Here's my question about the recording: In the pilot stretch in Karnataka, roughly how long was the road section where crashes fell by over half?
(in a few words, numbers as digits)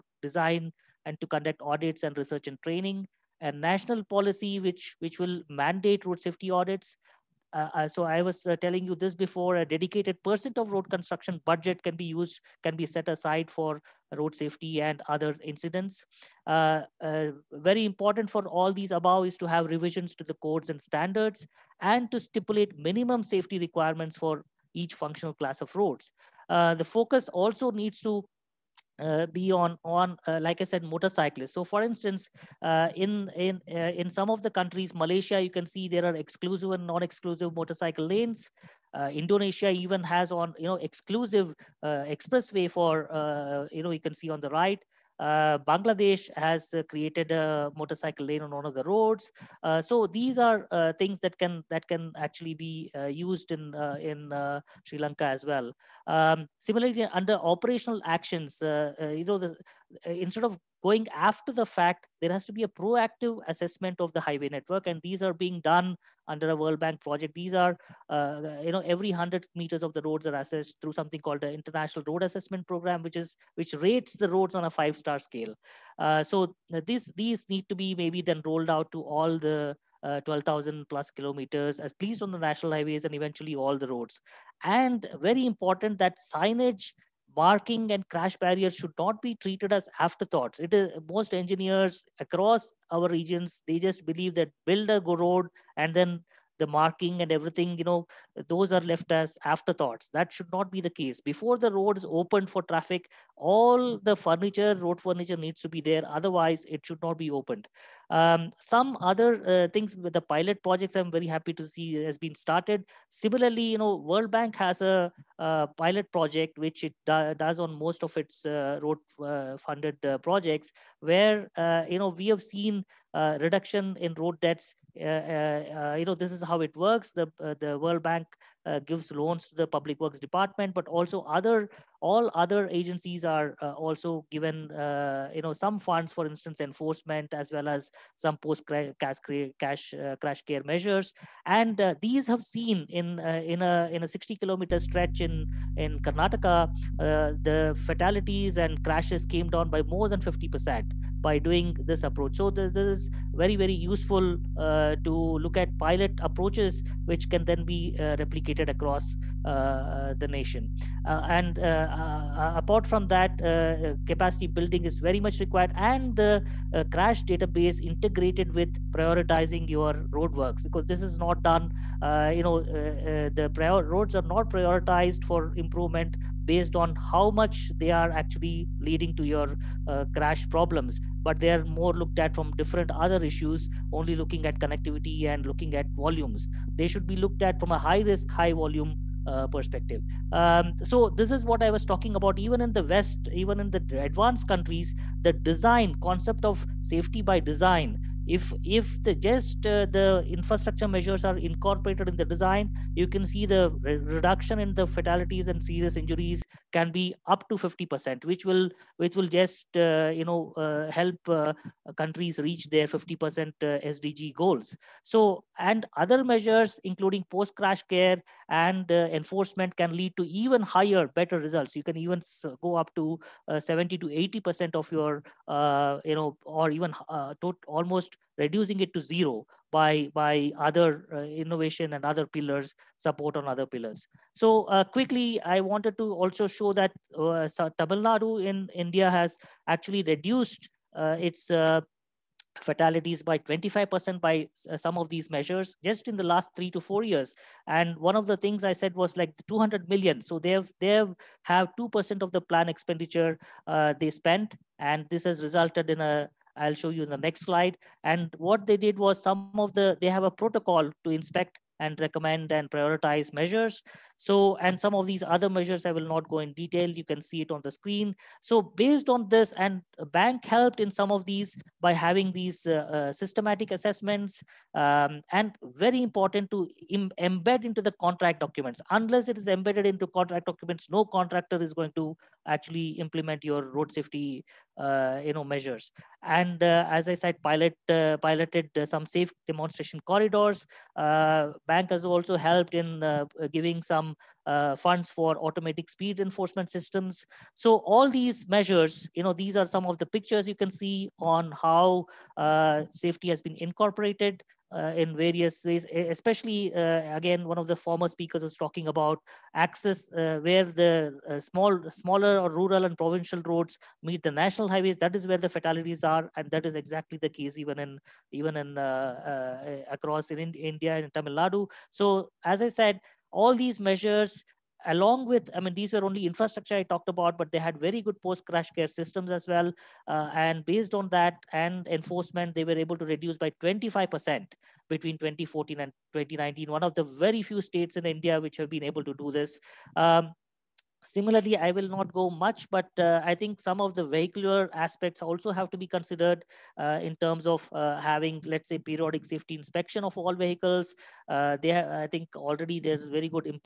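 60 kilometers.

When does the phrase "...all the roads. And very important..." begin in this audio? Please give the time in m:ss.
1:23.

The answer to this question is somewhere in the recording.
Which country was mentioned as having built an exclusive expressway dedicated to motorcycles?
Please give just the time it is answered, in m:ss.
0:39.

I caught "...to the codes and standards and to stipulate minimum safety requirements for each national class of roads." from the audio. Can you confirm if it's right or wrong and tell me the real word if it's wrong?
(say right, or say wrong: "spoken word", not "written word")
wrong: "functional", not "national".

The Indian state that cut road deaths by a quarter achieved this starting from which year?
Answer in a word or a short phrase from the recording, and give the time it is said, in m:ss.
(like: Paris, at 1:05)
2014, at 5:35.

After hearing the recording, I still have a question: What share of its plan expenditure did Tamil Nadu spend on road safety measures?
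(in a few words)
2%.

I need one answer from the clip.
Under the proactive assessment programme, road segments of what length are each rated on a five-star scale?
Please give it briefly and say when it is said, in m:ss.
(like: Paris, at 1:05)
100 meters, at 1:08.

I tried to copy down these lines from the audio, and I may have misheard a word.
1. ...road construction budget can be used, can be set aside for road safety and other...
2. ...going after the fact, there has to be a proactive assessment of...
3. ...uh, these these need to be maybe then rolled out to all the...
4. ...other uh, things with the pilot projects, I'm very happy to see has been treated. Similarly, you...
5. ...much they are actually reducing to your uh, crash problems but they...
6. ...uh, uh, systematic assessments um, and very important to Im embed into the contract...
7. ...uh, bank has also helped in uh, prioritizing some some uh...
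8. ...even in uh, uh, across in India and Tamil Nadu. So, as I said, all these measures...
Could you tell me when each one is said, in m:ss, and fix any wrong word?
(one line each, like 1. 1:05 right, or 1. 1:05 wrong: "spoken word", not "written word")
1. 0:10 right
2. 1:00 right
3. 1:16 right
4. 1:49 wrong: "started", not "treated"
5. 2:57 wrong: "leading", not "reducing"
6. 4:32 right
7. 4:50 wrong: "giving", not "prioritizing"
8. 5:18 right.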